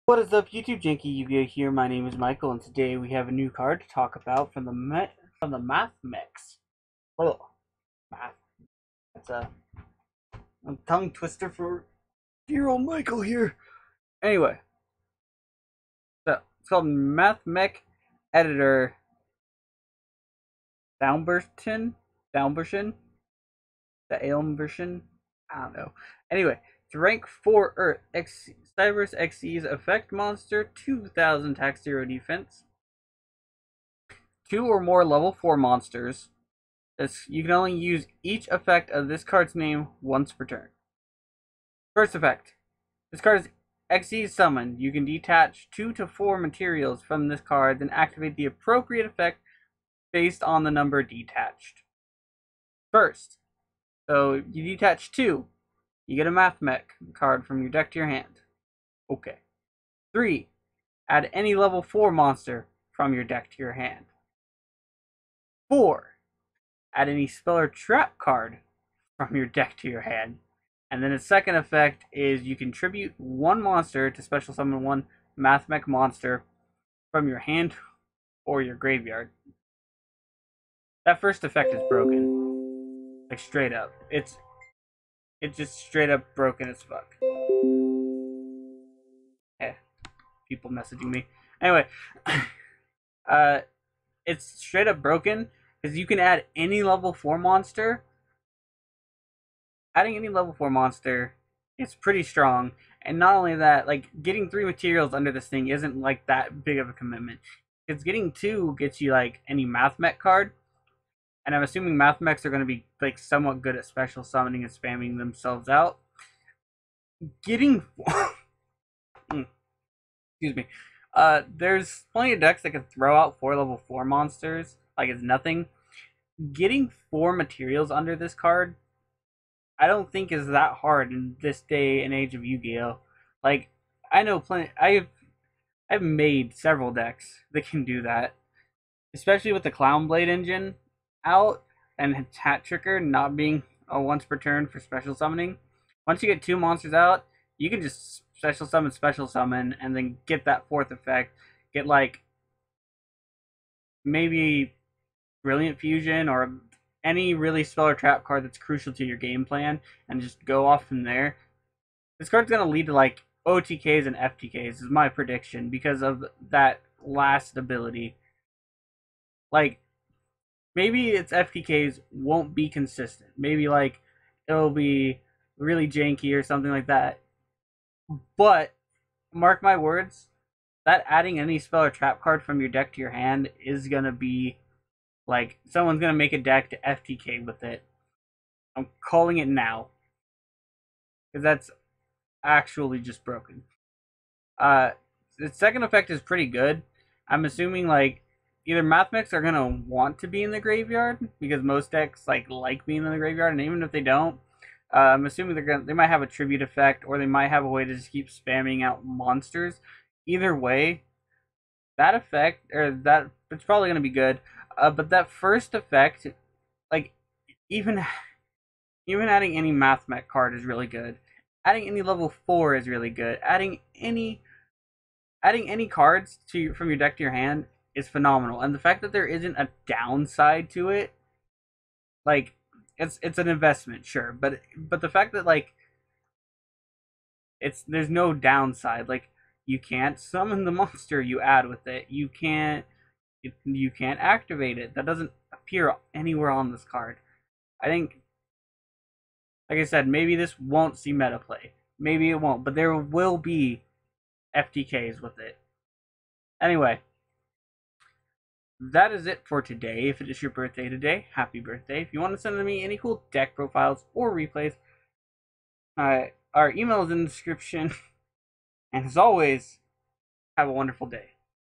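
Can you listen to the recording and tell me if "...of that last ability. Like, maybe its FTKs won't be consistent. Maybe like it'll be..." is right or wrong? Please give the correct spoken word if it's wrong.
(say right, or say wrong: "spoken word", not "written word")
right.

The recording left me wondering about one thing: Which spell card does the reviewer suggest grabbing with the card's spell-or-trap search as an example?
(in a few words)
Brilliant Fusion.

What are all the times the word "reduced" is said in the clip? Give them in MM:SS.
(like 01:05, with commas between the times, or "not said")
not said.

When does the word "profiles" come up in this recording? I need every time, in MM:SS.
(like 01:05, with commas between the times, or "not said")
04:23.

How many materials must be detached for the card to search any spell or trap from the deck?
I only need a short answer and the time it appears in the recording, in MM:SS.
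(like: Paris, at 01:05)
4, at 01:05.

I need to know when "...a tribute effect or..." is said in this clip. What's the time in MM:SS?
03:26.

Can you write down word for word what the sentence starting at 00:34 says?
Two or more level 4 monsters.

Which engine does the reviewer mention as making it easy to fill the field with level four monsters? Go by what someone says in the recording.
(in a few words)
Clown Blade.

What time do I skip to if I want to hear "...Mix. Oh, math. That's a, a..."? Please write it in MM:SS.
00:06.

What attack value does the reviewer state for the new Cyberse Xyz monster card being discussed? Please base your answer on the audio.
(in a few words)
2000.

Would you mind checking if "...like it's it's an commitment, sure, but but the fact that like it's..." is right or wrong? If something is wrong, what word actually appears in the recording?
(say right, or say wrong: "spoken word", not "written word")
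wrong: "investment", not "commitment".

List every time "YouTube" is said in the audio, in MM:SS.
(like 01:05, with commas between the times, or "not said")
00:00.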